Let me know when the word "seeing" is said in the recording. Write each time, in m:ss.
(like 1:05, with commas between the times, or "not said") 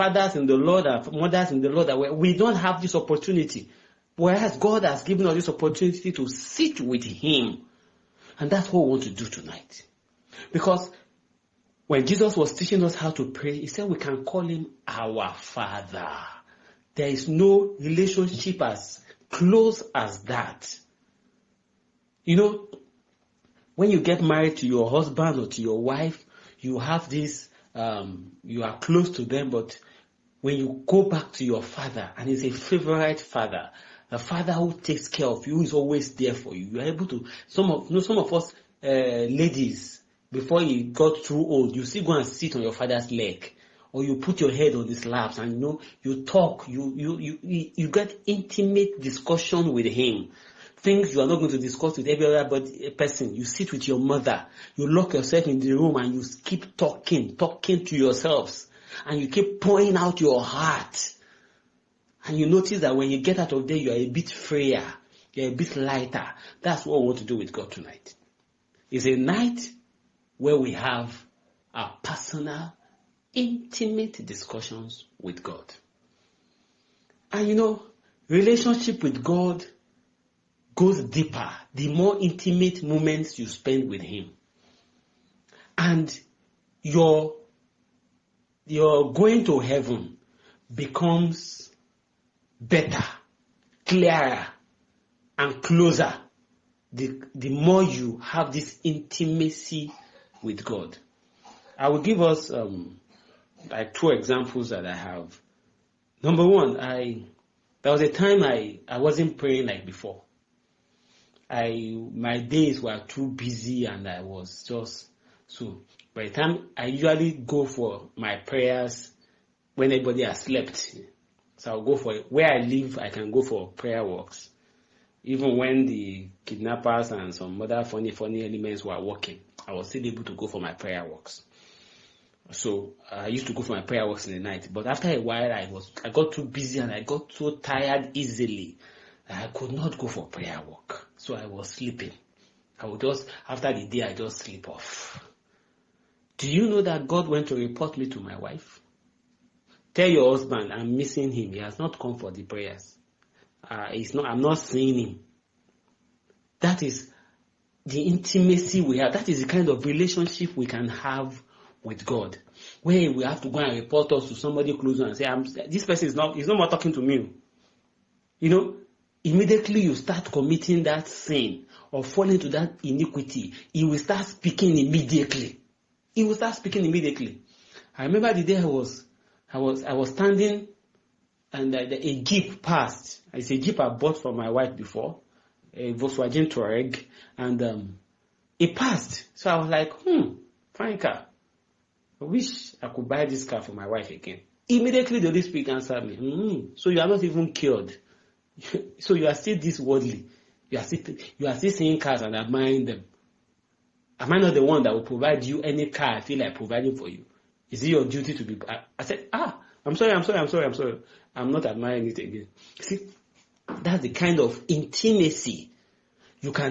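2:34, 3:21.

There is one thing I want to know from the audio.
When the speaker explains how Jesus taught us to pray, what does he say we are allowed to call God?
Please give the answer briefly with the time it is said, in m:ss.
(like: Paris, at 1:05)
Our father, at 0:14.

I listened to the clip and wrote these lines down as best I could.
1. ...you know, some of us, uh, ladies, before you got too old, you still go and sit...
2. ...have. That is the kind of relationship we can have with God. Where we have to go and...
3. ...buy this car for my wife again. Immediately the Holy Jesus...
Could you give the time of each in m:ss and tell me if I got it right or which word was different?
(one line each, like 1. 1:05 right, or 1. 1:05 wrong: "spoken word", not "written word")
1. 0:37 right
2. 2:38 right
3. 3:13 wrong: "Spirit", not "Jesus".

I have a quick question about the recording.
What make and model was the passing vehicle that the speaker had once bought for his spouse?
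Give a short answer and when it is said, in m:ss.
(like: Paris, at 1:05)
Volkswagen Touareg, at 3:05.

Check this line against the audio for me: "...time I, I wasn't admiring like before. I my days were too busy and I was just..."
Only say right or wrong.
wrong.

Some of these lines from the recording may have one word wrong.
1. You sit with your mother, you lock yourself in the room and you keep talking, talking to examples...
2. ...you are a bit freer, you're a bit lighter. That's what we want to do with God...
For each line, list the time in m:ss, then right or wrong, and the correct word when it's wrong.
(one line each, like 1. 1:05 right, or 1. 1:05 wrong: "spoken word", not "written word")
1. 0:53 wrong: "yourselves", not "examples"
2. 1:03 right.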